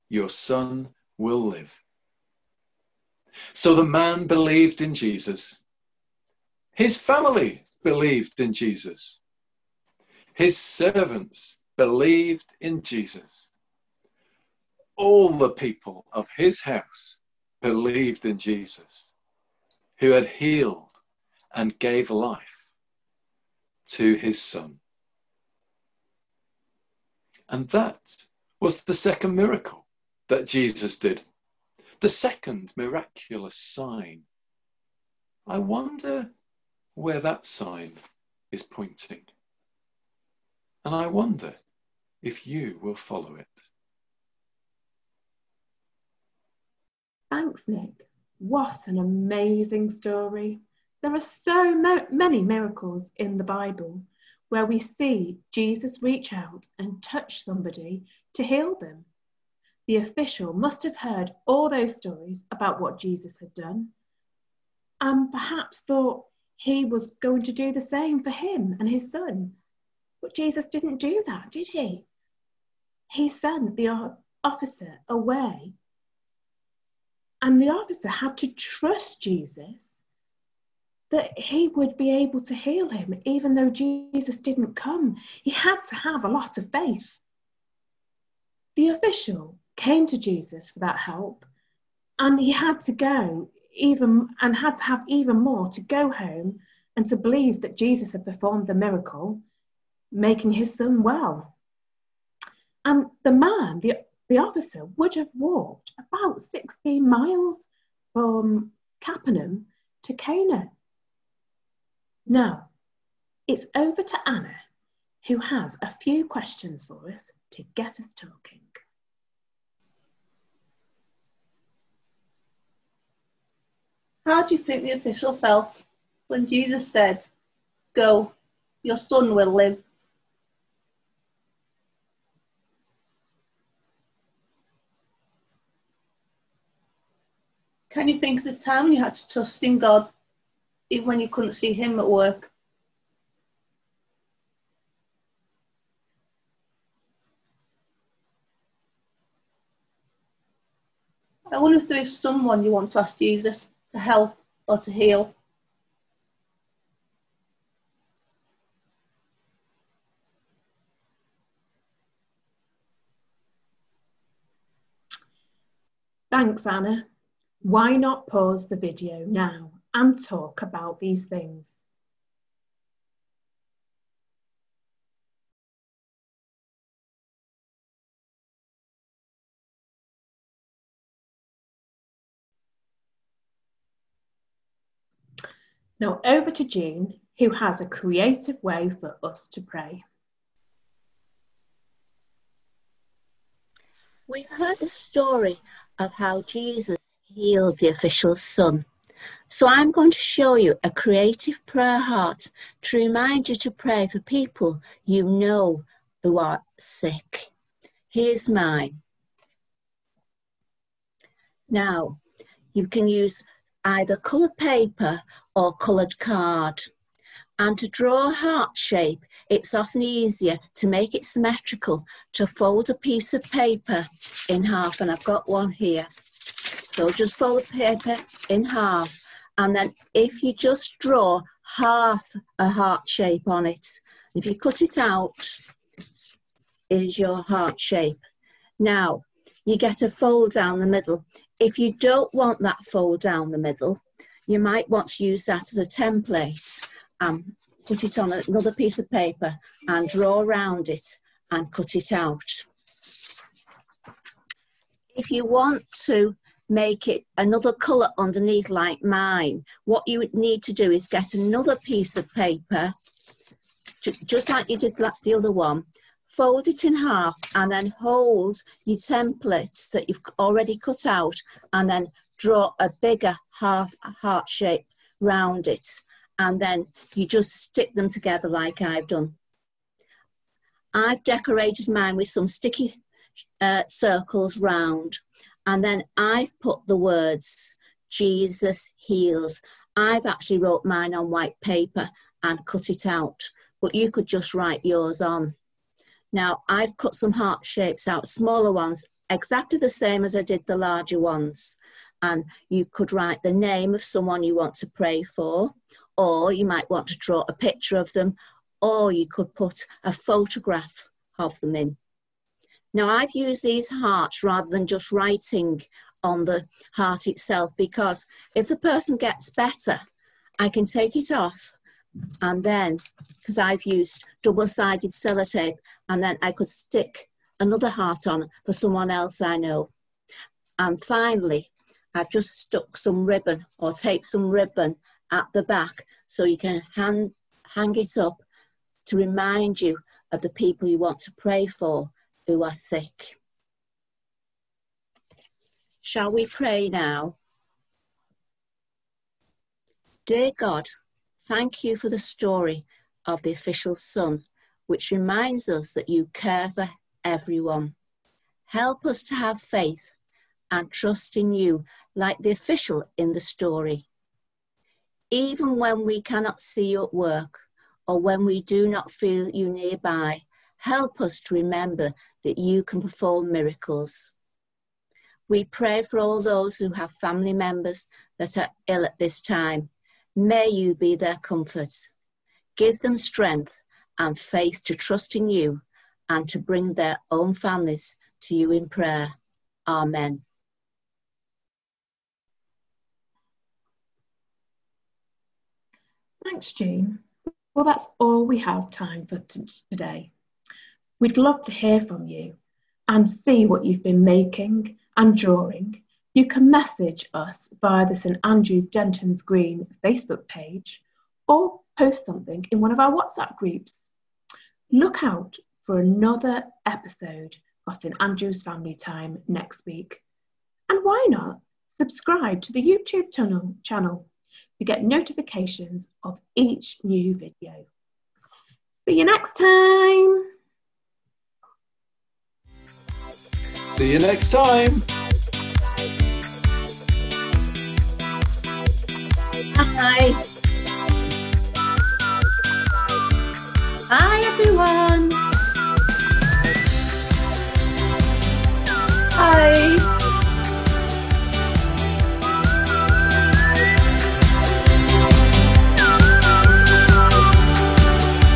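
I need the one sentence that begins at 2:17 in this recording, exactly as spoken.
Can you think of the time you had to trust in God, even when you couldn't see Him at work?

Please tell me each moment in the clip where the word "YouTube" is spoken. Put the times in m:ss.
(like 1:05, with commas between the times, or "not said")
7:02.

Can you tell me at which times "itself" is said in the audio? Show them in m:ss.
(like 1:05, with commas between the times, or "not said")
5:17.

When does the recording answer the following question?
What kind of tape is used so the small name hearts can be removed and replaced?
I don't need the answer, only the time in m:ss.
5:24.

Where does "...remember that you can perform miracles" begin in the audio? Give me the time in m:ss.
6:11.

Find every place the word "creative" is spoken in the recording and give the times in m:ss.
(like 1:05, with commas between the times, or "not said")
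3:07, 3:20.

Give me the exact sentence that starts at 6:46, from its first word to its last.
You can message us via the St Andrews Dentons Green Facebook page or post something in one of our WhatsApp groups.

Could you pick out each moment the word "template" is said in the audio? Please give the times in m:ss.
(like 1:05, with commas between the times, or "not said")
4:05, 4:28.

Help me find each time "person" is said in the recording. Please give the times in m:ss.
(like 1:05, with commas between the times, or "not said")
5:18.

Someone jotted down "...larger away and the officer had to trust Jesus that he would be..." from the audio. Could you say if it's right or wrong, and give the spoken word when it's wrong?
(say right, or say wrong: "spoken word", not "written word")
wrong: "officer", not "larger".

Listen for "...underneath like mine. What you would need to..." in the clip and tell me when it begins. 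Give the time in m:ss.
4:18.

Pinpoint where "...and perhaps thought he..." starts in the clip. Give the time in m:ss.
1:05.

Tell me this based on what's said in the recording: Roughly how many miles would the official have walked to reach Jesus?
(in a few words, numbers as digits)
16.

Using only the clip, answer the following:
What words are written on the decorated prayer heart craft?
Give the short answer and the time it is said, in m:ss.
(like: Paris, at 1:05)
Jesus heals, at 4:48.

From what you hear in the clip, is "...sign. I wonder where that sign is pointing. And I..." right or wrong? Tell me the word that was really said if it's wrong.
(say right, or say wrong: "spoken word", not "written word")
right.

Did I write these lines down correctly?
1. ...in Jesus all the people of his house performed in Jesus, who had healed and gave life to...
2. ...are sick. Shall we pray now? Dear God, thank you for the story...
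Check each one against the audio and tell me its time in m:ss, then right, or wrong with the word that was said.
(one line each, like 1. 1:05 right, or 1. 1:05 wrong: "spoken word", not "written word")
1. 0:12 wrong: "believed", not "performed"
2. 5:42 right.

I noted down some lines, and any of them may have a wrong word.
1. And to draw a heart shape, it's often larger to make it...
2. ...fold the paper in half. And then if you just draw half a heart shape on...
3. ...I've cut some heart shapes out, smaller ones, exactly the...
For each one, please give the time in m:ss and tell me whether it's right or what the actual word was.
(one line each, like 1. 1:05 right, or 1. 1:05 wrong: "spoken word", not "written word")
1. 3:37 wrong: "easier", not "larger"
2. 3:47 right
3. 4:56 right.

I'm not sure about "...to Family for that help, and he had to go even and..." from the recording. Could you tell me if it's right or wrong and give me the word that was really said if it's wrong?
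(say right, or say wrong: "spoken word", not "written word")
wrong: "Jesus", not "Family".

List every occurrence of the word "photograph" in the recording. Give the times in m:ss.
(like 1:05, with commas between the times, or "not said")
5:10.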